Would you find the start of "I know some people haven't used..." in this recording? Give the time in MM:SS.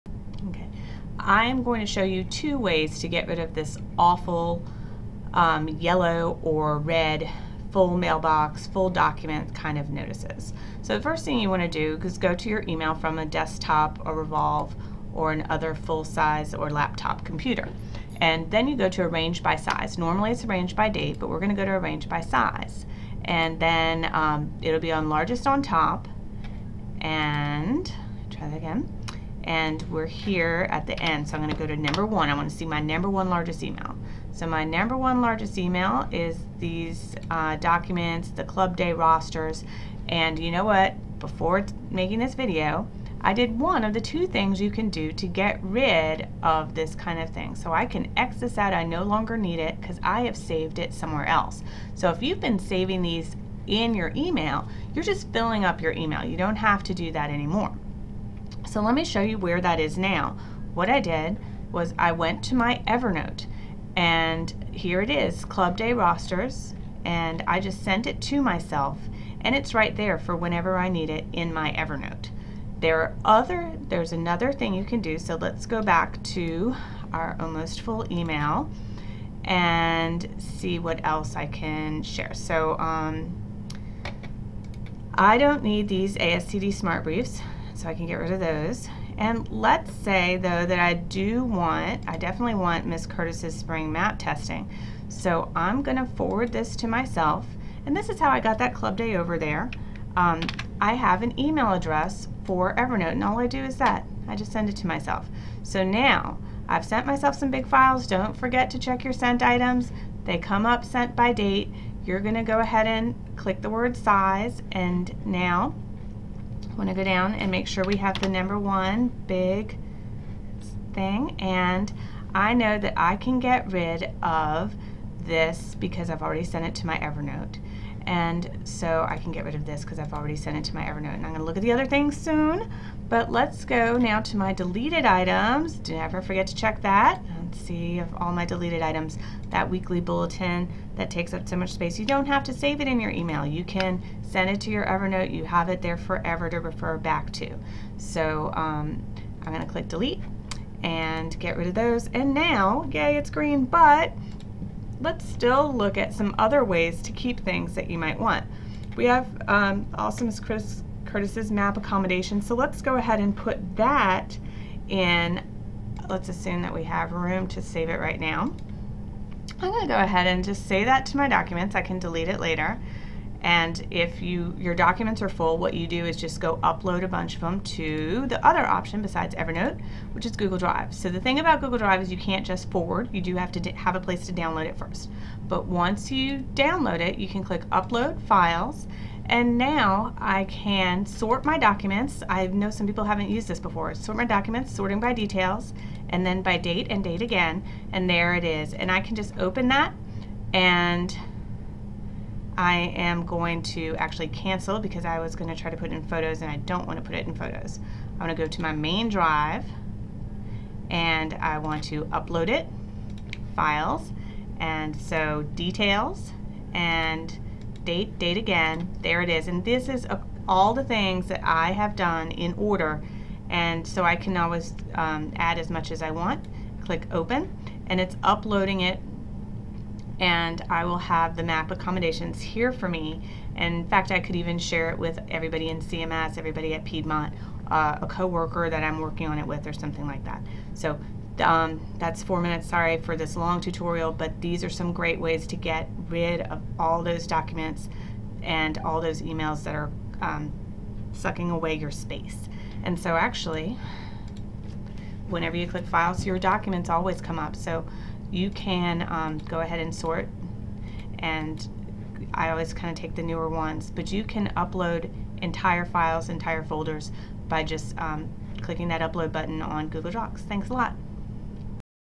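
03:12.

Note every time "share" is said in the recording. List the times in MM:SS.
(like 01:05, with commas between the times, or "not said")
01:22, 03:54.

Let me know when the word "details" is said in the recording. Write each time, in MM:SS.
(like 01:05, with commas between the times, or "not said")
03:15, 03:35.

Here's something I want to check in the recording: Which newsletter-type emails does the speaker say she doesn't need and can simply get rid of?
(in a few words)
ASCD Smart Briefs.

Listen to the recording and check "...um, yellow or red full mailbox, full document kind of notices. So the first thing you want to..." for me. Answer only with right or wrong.
right.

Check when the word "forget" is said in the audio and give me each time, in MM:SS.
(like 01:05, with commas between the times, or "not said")
01:48, 02:16.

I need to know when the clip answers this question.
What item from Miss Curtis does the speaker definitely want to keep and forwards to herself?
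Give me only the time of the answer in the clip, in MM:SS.
01:33.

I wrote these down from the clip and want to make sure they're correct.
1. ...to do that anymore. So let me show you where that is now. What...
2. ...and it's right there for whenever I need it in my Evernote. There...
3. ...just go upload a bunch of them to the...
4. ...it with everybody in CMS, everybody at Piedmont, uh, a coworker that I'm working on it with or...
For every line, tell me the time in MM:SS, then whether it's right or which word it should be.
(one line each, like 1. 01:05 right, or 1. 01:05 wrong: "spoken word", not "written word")
1. 00:56 right
2. 01:09 right
3. 02:56 right
4. 03:54 right.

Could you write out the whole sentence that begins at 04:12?
And so actually, whenever you click files, your documents always come up.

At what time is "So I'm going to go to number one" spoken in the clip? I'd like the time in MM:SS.
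00:31.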